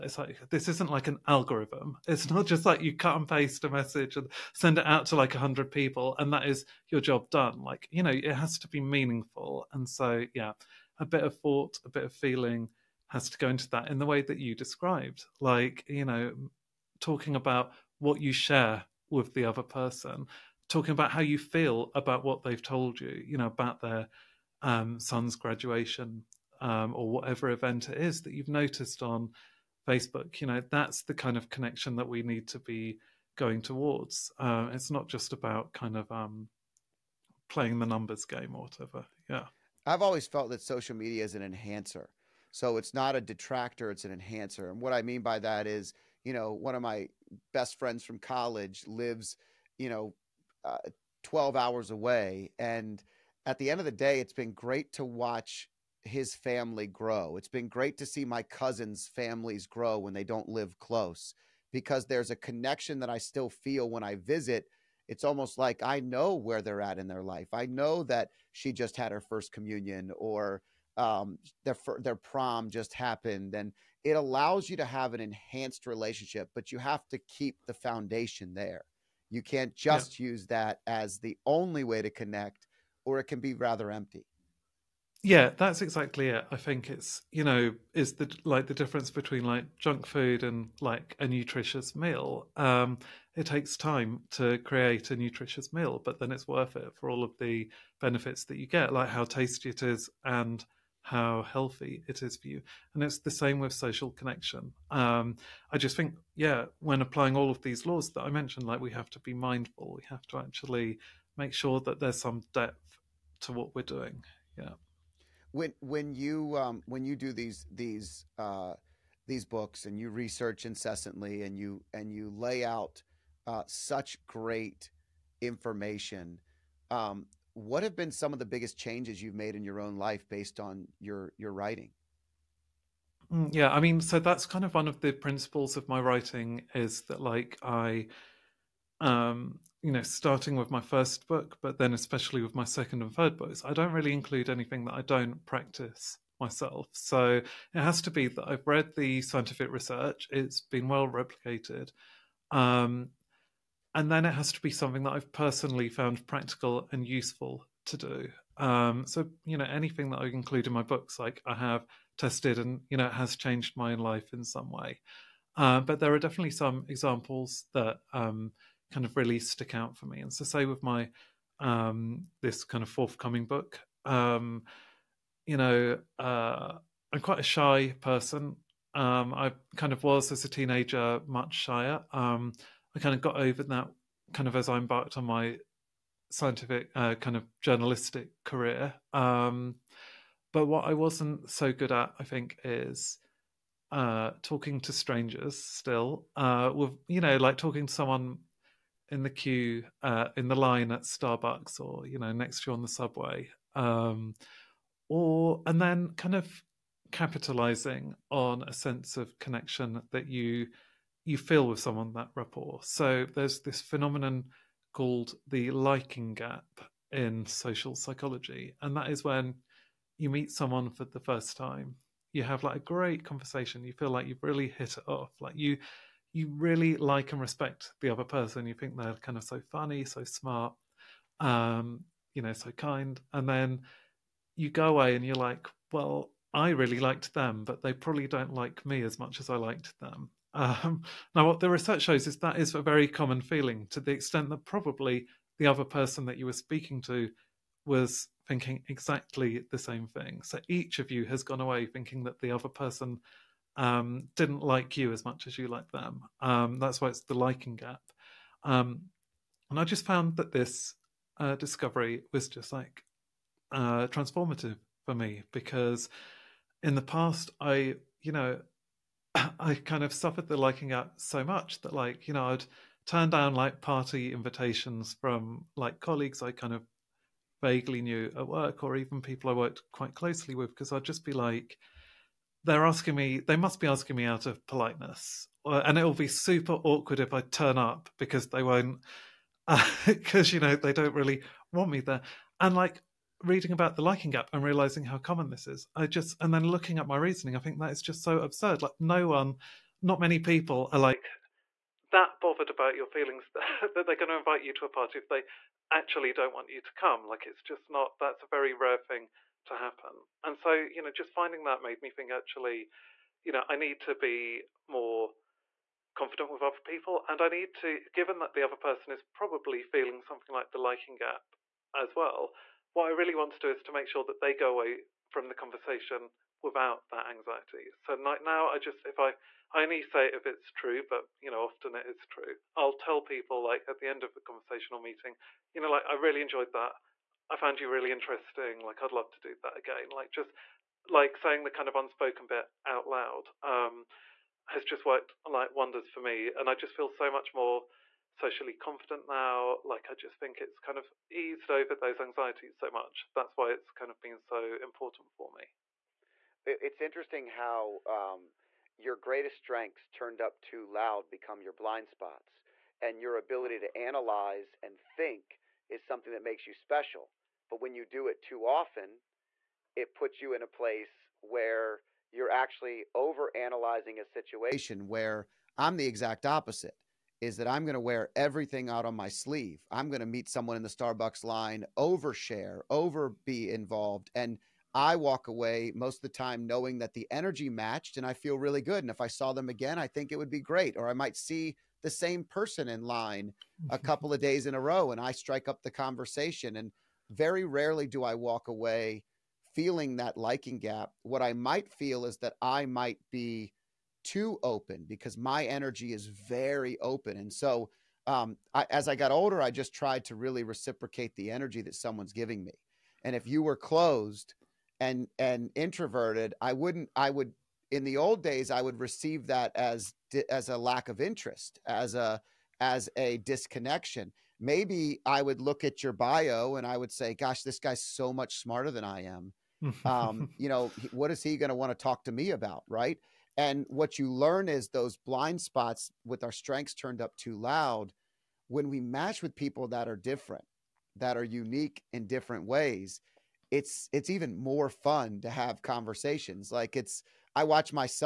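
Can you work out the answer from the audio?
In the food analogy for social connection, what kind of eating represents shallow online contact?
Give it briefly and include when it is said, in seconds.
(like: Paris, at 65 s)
junk food, at 89 s.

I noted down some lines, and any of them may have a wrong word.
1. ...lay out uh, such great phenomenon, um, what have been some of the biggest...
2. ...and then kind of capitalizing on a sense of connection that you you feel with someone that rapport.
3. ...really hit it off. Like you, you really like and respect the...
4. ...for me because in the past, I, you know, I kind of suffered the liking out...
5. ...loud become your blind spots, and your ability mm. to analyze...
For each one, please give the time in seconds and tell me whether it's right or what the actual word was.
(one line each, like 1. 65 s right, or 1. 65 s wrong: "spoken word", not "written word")
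1. 122 s wrong: "information", not "phenomenon"
2. 205 s right
3. 224 s right
4. 265 s right
5. 360 s right.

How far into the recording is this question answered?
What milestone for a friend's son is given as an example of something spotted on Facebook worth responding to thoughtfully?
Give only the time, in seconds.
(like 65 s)
25 s.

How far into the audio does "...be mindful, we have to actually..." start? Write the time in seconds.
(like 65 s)
109 s.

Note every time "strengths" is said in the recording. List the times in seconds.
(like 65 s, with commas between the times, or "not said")
359 s, 436 s.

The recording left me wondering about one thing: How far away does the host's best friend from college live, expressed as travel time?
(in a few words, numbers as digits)
12 hours.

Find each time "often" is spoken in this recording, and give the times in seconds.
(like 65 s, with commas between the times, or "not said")
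331 s, 368 s.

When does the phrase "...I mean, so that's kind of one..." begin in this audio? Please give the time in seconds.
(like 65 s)
133 s.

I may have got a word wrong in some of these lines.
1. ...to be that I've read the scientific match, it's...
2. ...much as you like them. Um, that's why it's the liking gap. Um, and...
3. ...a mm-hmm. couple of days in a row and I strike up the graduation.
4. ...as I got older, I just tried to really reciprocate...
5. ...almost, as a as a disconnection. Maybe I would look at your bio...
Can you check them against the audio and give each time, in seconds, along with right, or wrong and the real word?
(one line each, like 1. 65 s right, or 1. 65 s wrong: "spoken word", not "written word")
1. 148 s wrong: "research", not "match"
2. 255 s right
3. 393 s wrong: "conversation", not "graduation"
4. 408 s right
5. 421 s wrong: "interest", not "almost".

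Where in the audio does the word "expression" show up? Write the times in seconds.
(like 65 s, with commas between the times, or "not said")
not said.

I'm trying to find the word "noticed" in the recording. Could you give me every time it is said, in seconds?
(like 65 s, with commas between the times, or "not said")
28 s.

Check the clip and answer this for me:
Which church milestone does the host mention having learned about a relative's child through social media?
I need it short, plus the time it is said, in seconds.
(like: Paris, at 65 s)
first communion, at 69 s.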